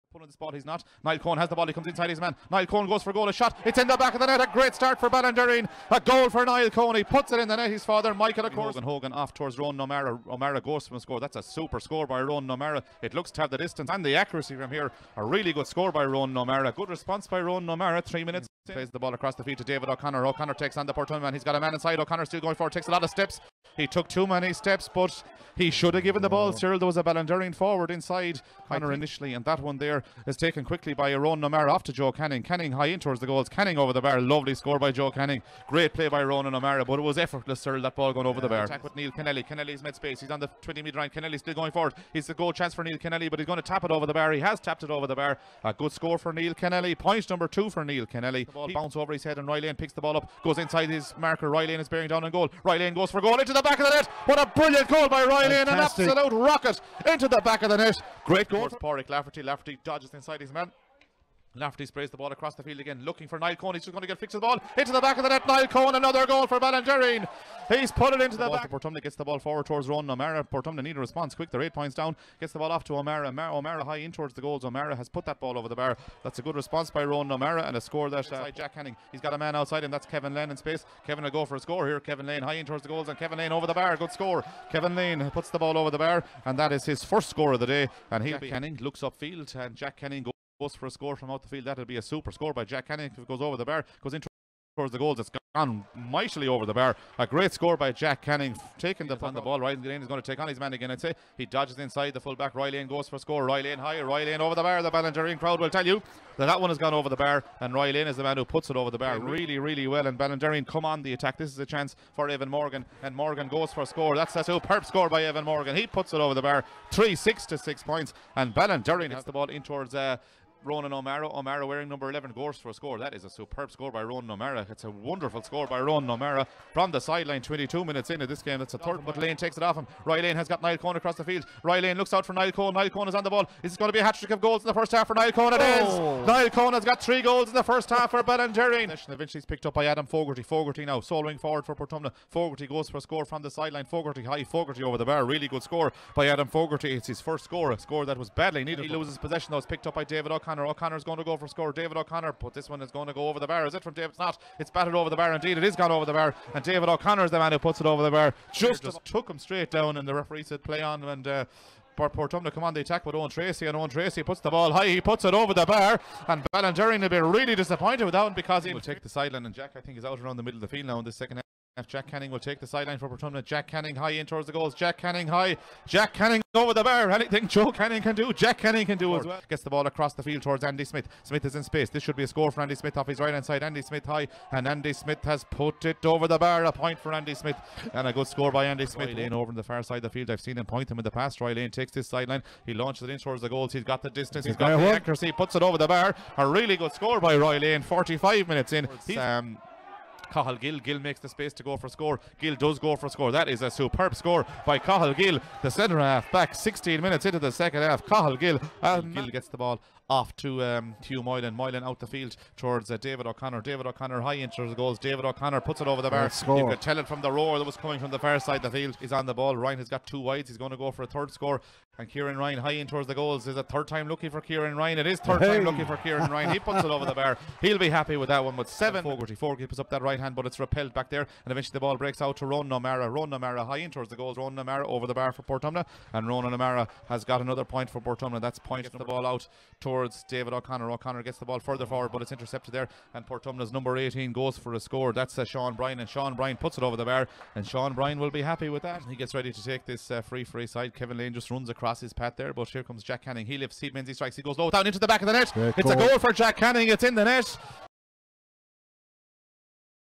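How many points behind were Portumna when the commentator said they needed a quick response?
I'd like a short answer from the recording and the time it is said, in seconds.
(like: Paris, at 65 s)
8, at 71 s.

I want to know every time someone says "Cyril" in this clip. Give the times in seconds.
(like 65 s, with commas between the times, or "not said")
26 s, 37 s.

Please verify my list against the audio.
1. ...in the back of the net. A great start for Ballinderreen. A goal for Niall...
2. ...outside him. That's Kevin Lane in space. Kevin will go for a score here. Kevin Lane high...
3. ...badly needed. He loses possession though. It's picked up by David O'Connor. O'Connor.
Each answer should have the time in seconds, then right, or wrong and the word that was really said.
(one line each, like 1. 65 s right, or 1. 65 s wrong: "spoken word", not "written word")
1. 3 s right
2. 79 s right
3. 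148 s right.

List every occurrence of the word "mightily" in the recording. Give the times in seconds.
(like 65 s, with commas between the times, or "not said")
95 s.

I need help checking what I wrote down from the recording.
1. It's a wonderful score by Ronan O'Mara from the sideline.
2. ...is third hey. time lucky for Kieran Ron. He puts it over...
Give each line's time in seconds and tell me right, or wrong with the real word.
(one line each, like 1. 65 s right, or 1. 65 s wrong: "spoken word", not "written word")
1. 124 s right
2. 225 s wrong: "Ryan", not "Ron".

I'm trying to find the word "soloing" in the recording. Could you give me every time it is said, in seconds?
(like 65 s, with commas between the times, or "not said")
140 s.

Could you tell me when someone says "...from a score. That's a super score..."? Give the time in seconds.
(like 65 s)
10 s.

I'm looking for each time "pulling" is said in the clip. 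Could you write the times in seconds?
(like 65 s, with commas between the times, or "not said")
0 s.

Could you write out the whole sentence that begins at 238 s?
That's points the ball out towards towards David O'Connor.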